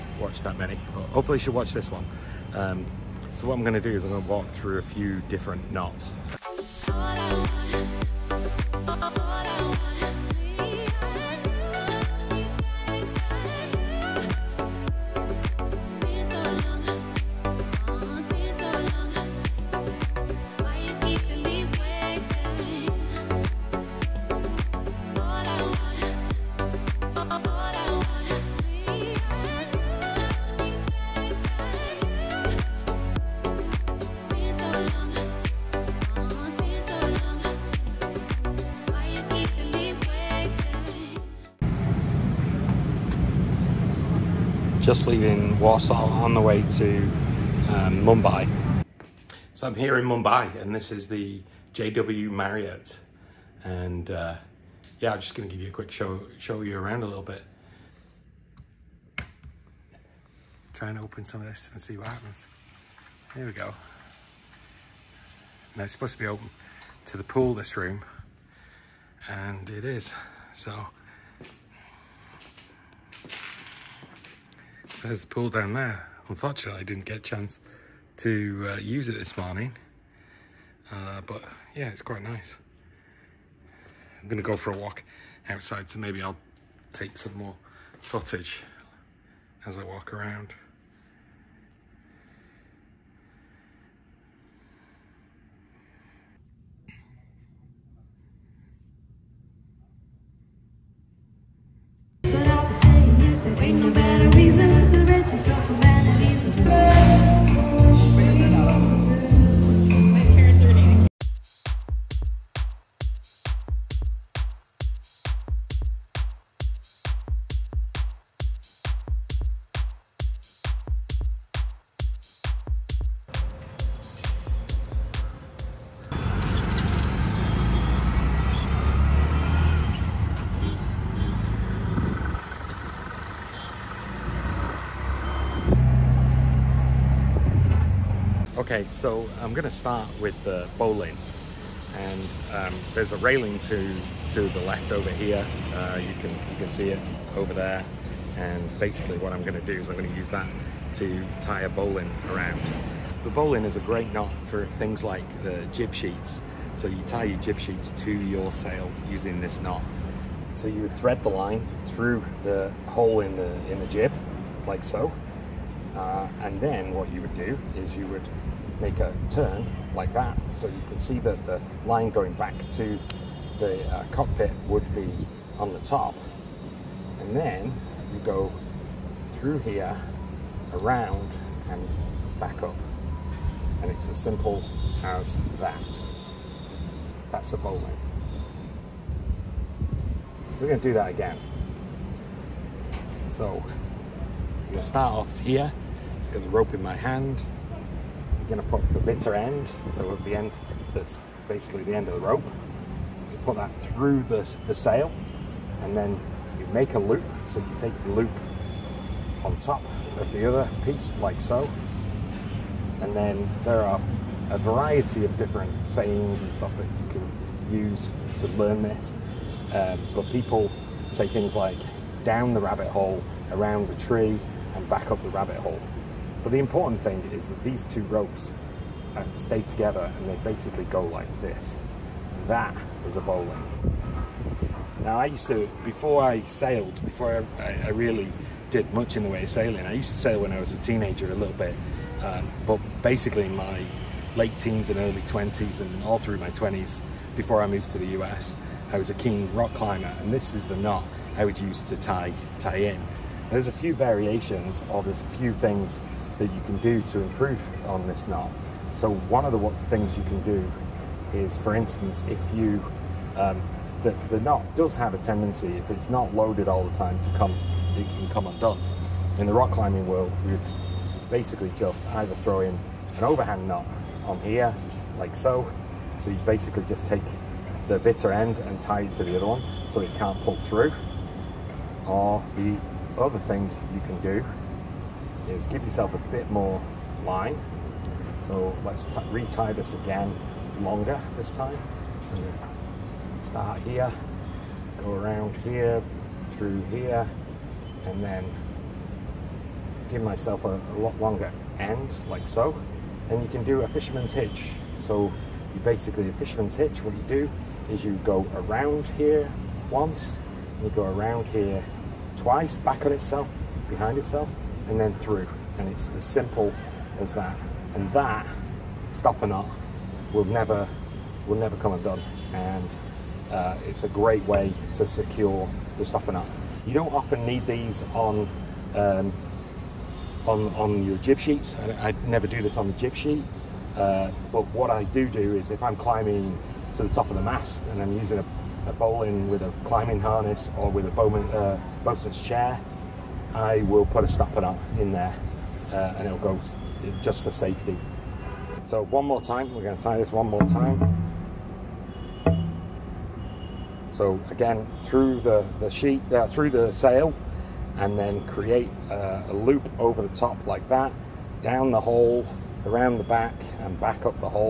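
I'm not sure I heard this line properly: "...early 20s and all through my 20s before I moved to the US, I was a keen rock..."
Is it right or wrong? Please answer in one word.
right.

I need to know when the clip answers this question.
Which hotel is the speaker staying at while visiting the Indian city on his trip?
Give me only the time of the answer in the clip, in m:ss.
0:51.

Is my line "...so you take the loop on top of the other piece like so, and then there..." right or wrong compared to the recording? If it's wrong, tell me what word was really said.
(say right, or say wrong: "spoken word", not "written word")
right.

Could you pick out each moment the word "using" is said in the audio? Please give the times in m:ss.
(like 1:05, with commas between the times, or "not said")
2:39, 5:38.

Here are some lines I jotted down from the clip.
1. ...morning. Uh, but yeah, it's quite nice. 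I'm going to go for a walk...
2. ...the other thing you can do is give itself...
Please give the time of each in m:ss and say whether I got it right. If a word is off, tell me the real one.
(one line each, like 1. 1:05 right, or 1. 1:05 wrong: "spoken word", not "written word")
1. 1:19 right
2. 4:42 wrong: "yourself", not "itself".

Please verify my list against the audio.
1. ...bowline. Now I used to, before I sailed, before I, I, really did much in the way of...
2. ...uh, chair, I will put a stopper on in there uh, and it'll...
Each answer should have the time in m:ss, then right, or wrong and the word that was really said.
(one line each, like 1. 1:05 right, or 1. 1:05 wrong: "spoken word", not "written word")
1. 3:53 right
2. 5:41 right.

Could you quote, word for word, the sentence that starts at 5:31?
I, I, never do this on the jib sheet.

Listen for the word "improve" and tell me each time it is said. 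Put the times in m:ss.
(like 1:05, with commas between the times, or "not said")
4:17.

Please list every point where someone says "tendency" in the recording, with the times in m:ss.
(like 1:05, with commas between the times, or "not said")
4:25.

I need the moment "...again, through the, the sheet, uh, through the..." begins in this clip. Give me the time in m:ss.
5:54.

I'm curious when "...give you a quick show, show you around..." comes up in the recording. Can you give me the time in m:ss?
0:55.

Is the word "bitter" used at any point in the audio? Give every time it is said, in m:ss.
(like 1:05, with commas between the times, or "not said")
3:18, 4:37.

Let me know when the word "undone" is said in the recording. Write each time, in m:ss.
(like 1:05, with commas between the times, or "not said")
4:28, 5:21.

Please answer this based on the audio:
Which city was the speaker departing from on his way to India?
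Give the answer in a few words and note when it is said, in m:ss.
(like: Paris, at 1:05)
Warsaw, at 0:45.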